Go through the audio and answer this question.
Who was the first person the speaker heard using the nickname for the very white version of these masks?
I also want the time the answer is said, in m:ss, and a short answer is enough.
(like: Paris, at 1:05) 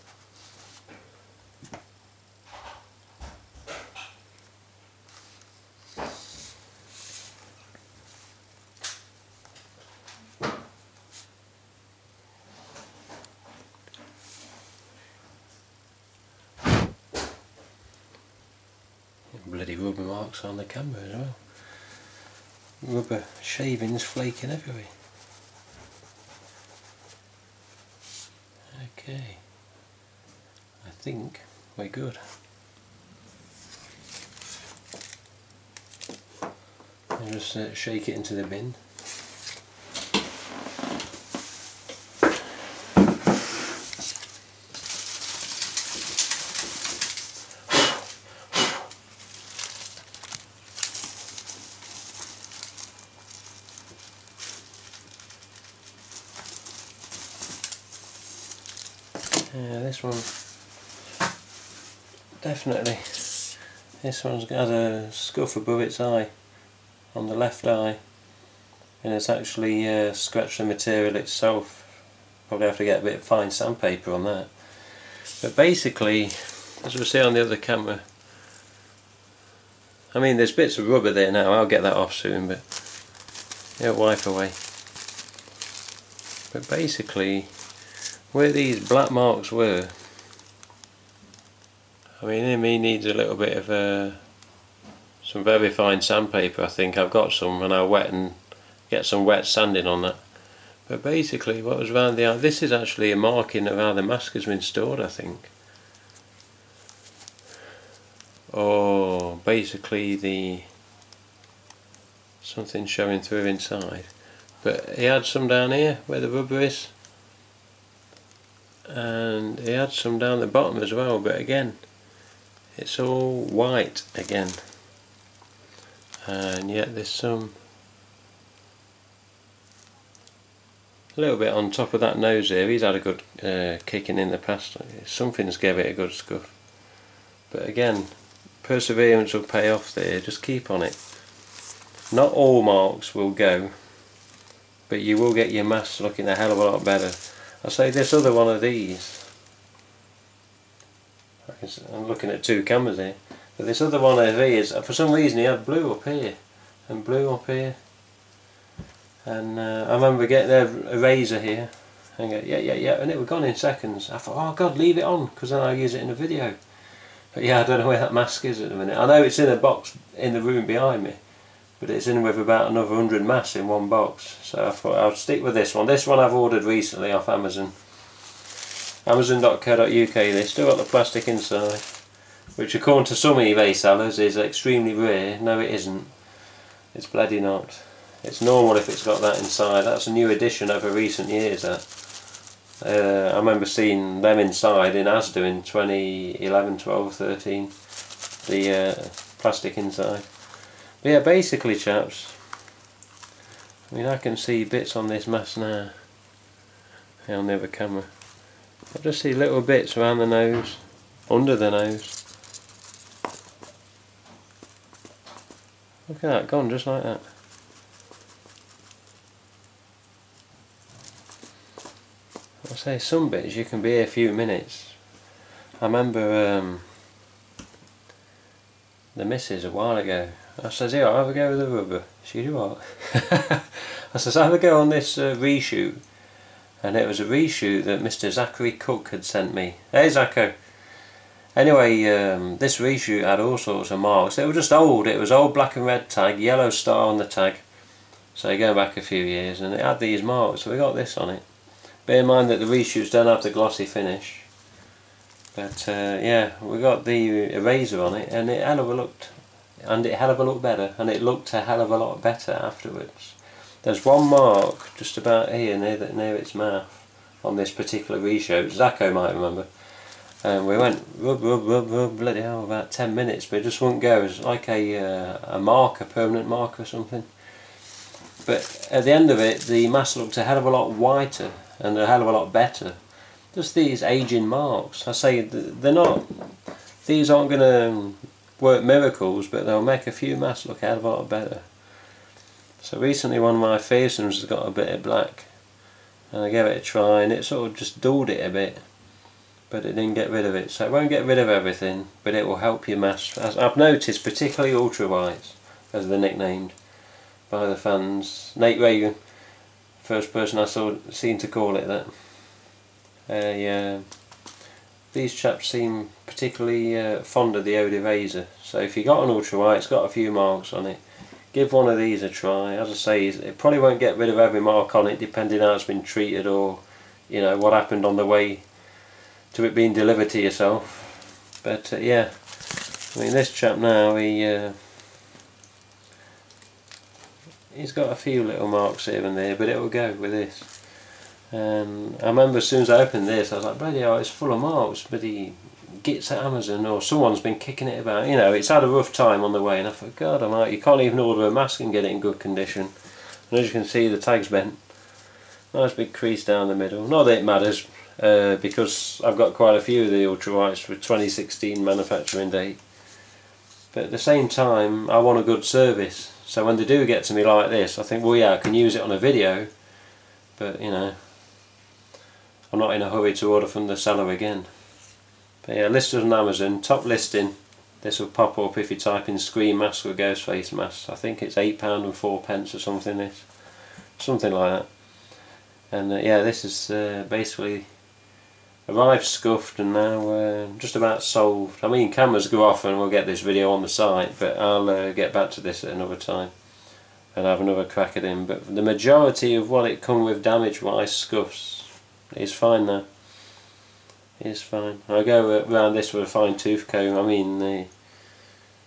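Nate Reagan, at 5:08.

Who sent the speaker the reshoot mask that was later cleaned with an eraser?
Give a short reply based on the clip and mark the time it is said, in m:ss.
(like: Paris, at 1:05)
Zachary Cook, at 3:58.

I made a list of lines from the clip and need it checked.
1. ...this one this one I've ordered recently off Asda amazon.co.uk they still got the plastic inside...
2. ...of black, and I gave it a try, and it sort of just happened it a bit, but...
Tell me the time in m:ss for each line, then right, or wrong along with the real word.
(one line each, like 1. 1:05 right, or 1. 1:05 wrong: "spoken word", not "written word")
1. 2:55 wrong: "Amazon", not "Asda"
2. 4:54 wrong: "dulled", not "happened".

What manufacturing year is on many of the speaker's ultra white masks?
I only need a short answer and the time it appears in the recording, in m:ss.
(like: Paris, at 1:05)
2016, at 6:01.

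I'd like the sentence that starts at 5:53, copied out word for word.
And as you can see, the tag's bent.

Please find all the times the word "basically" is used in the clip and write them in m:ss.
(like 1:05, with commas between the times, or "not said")
1:15, 1:26, 1:41, 1:49, 3:21, 6:27.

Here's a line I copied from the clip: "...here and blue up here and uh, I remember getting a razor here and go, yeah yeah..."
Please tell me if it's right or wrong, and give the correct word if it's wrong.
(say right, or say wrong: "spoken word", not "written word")
right.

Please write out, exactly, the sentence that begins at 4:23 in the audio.
There's one mark just about here near, the, near its mouth on this particular reshoot, Zacho might remember.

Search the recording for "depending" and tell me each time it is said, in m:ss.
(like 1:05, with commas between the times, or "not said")
5:25.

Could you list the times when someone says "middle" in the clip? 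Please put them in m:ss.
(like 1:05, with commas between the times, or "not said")
5:56.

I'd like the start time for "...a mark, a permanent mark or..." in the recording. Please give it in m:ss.
4:35.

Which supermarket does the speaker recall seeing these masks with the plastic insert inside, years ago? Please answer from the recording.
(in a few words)
Asda.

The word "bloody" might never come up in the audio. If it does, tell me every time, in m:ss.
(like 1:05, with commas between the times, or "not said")
0:19, 3:07, 4:32, 5:43.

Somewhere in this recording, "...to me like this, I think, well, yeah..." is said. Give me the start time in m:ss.
6:07.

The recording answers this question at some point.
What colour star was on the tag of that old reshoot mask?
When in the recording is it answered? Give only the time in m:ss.
4:06.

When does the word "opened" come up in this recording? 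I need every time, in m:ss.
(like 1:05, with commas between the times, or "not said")
5:43.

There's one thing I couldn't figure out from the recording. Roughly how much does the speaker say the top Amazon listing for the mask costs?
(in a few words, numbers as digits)
8 pounds 4 pence.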